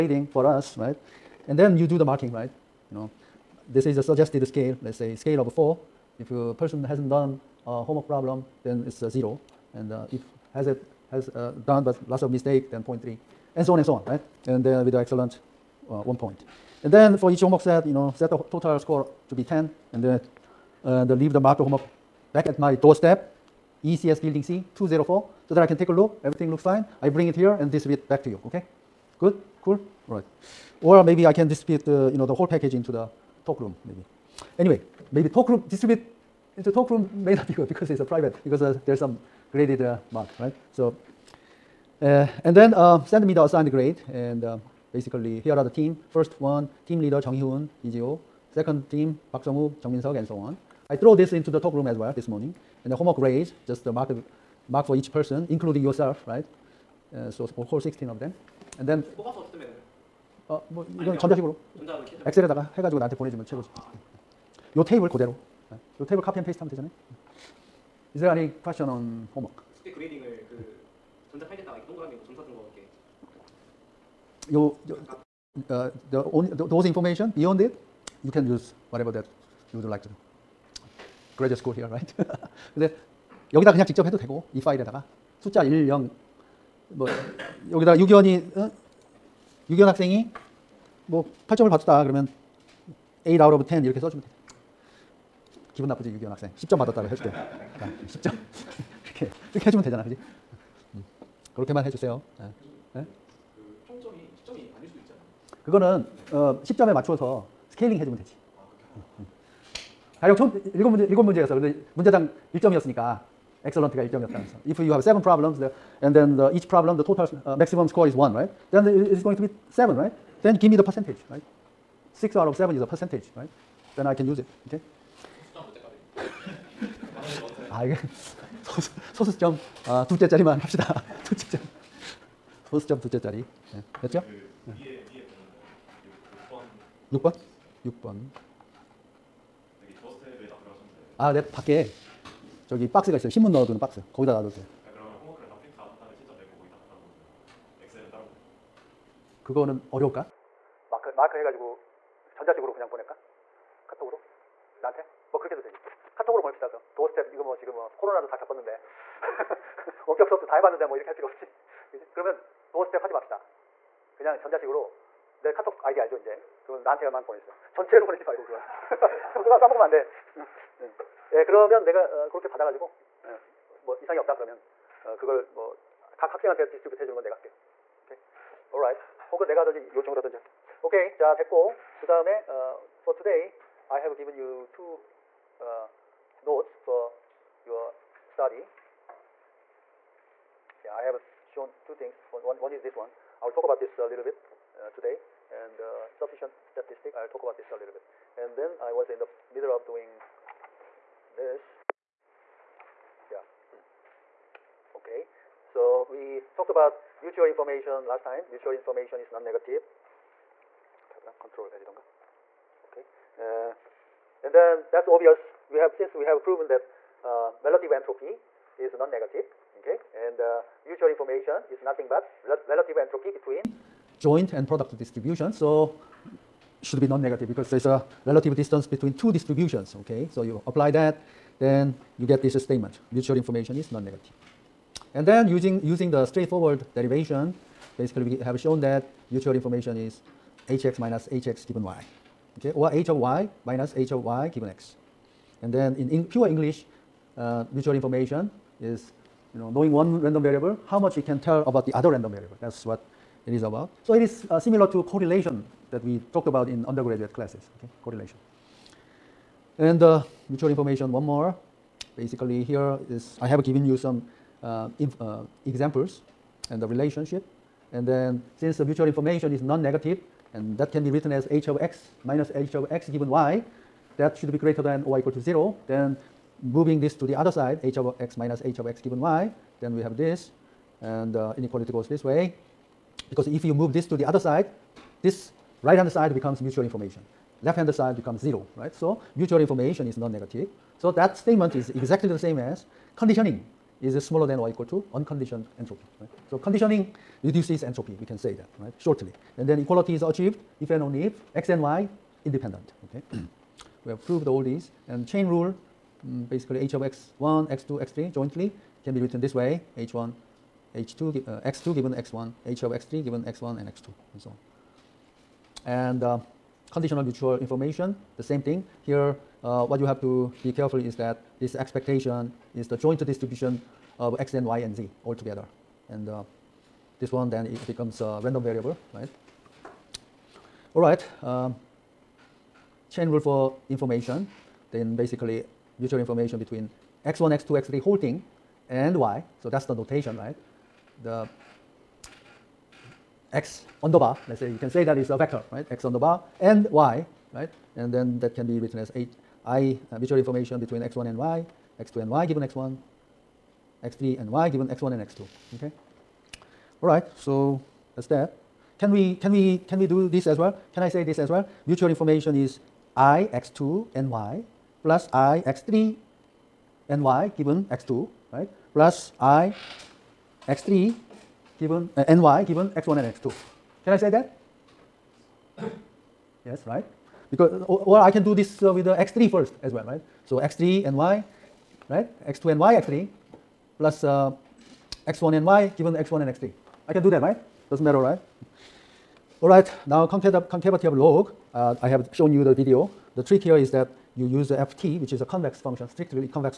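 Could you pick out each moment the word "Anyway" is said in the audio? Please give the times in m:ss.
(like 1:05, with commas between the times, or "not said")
0:34.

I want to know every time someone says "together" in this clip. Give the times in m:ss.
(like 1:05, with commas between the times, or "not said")
5:25.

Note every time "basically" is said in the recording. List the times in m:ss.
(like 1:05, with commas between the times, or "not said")
0:44, 3:58, 4:22, 5:06, 5:35.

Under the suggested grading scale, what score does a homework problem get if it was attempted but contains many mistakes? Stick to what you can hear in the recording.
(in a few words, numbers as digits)
0.3.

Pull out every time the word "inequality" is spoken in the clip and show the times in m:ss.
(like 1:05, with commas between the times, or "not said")
4:41.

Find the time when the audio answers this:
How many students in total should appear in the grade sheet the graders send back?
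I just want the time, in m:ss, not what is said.
0:57.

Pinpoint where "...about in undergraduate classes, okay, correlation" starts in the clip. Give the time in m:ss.
4:16.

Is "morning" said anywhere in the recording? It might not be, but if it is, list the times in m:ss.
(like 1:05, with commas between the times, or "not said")
0:52.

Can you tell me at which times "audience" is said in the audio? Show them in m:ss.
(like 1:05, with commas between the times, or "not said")
not said.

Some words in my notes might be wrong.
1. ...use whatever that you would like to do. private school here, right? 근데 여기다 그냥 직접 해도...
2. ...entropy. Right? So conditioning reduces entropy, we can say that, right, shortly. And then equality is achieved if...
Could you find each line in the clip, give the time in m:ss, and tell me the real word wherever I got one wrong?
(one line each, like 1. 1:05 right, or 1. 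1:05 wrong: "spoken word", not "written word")
1. 1:18 wrong: "graduate", not "private"
2. 4:55 right.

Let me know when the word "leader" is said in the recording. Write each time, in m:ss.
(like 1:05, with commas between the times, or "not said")
0:47.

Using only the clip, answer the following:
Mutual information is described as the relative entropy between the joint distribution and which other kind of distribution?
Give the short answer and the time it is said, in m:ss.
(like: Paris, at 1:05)
product distribution, at 3:44.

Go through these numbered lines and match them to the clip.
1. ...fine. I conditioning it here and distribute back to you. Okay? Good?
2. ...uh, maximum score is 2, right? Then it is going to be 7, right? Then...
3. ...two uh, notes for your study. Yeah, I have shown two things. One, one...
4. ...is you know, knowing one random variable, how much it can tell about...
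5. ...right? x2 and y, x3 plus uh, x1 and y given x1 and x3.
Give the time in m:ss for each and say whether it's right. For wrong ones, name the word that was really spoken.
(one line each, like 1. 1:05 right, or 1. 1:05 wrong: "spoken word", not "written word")
1. 0:26 wrong: "bring", not "conditioning"
2. 1:57 wrong: "1", not "2"
3. 3:04 right
4. 4:08 right
5. 6:22 right.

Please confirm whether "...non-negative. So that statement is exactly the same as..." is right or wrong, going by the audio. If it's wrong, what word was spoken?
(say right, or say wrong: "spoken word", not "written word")
right.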